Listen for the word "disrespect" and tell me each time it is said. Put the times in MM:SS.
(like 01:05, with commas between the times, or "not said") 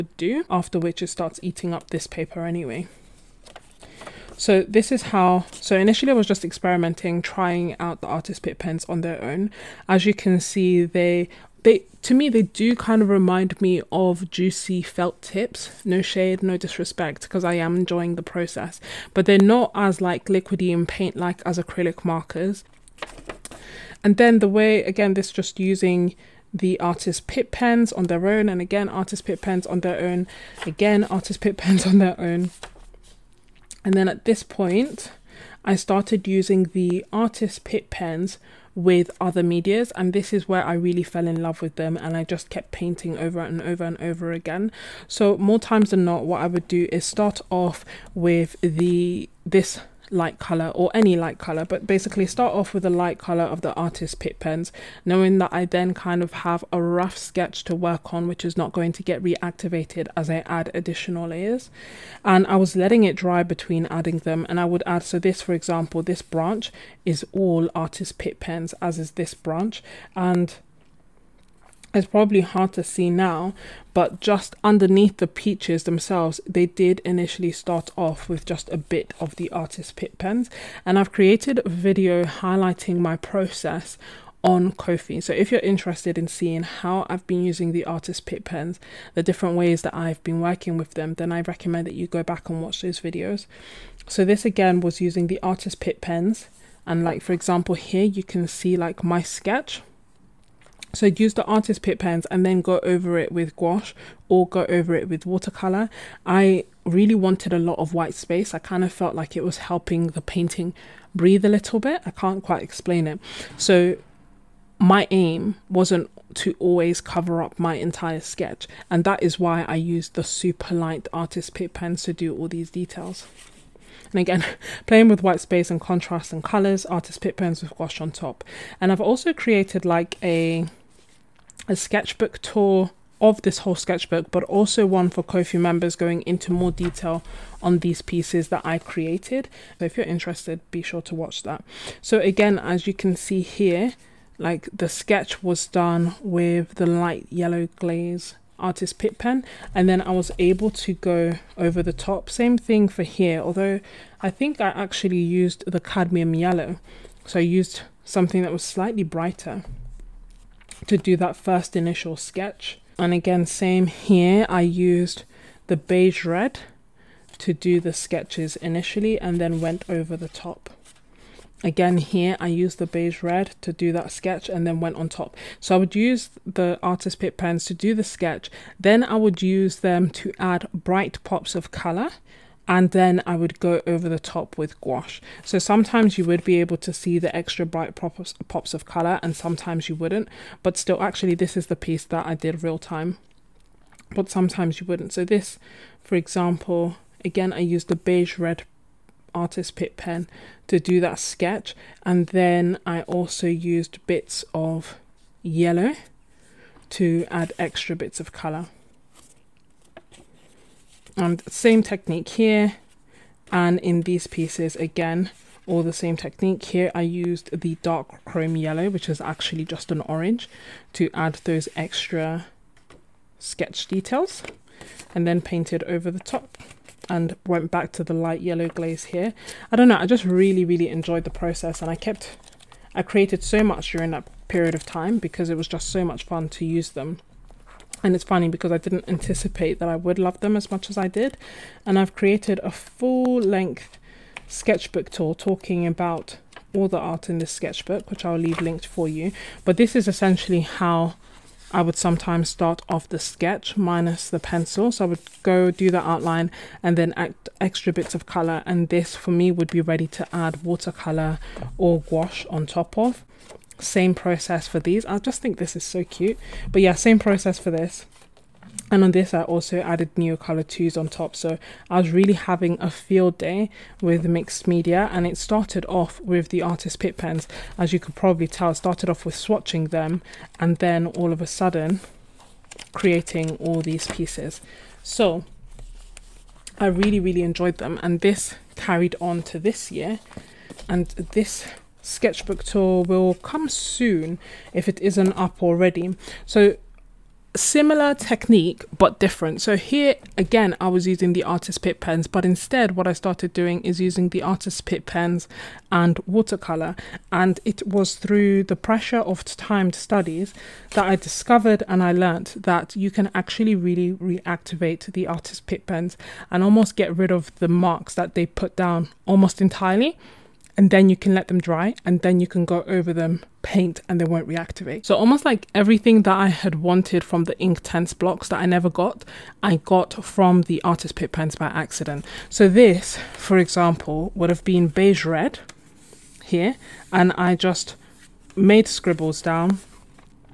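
00:16.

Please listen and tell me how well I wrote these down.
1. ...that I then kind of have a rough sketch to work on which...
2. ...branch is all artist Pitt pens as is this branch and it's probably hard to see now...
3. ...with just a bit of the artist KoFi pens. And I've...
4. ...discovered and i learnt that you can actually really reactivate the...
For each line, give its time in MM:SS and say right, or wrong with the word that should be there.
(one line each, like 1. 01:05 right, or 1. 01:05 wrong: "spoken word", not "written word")
1. 00:55 right
2. 01:06 right
3. 01:18 wrong: "Pitt", not "KoFi"
4. 05:11 right.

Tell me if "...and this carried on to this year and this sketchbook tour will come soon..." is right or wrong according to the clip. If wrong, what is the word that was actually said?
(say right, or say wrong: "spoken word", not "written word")
right.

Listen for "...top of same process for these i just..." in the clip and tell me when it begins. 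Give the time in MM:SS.
04:22.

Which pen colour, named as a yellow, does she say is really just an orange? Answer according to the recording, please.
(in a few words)
Dark chrome yellow.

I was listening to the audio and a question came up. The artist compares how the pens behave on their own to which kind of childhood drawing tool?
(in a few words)
Juicy felt tips.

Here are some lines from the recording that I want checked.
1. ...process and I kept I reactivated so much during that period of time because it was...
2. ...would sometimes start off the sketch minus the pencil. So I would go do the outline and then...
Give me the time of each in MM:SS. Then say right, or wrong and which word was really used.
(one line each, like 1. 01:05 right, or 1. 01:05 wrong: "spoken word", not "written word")
1. 03:51 wrong: "created", not "reactivated"
2. 04:11 right.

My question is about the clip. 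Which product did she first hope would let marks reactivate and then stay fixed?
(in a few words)
Inktense blocks.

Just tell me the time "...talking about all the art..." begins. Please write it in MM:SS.
04:05.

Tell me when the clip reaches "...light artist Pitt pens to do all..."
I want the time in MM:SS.
02:00.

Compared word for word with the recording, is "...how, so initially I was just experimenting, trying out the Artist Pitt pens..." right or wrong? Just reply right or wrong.
right.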